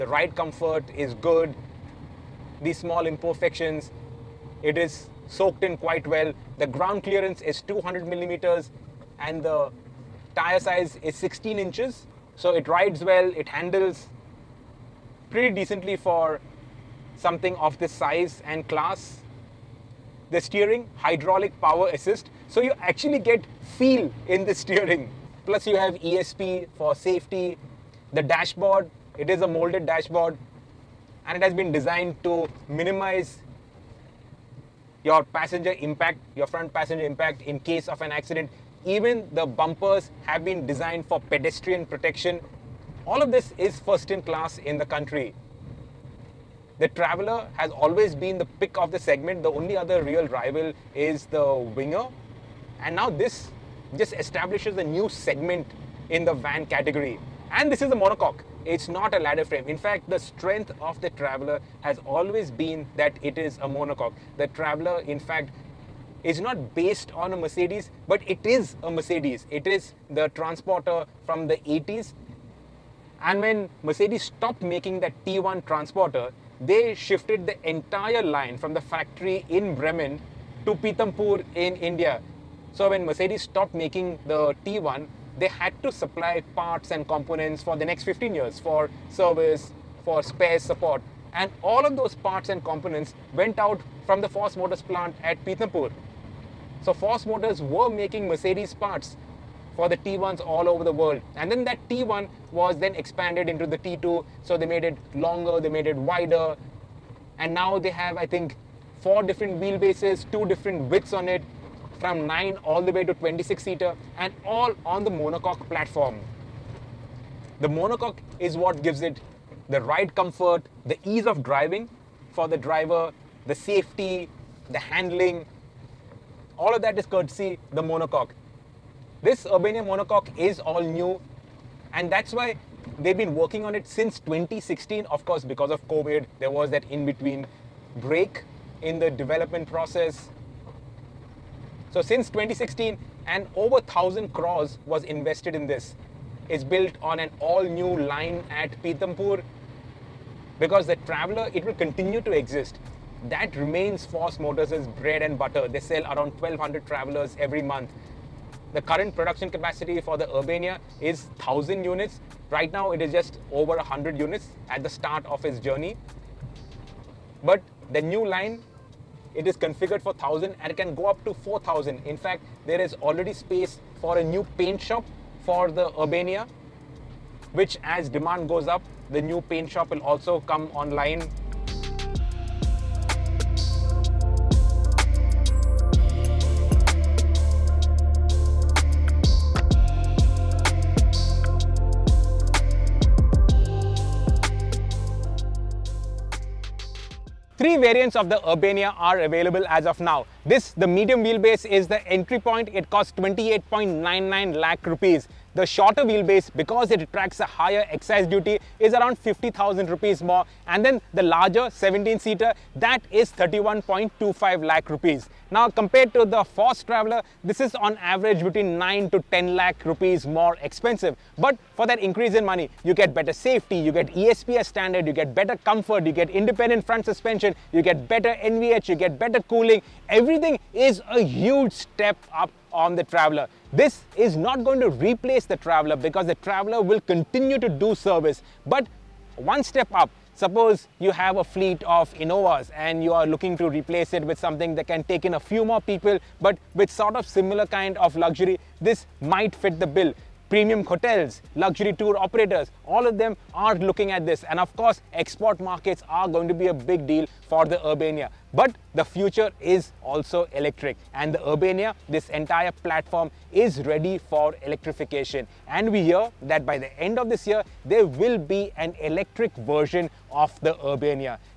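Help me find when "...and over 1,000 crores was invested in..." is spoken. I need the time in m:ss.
2:23.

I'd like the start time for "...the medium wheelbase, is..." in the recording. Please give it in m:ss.
3:20.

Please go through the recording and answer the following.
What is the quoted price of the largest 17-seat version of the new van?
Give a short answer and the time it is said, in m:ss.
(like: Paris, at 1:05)
31.25 lakh rupees, at 3:33.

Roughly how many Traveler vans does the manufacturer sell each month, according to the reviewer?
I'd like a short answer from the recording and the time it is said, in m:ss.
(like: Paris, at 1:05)
1,200, at 2:36.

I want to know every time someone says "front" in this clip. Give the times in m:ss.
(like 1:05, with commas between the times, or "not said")
0:36, 3:46.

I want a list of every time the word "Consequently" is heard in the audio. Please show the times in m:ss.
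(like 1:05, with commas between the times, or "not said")
not said.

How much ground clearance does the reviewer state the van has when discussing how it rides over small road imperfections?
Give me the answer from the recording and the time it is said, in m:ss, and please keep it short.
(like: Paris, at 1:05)
200 millimeters, at 0:07.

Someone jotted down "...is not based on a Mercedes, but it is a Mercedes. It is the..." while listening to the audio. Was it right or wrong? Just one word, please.
right.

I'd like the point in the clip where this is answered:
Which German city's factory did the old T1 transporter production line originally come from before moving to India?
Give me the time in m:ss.
1:19.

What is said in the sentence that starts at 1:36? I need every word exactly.
So Force Motors were making Mercedes parts for the T1s all over the world.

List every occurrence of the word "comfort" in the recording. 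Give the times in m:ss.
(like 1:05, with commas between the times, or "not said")
0:00, 2:00, 3:45.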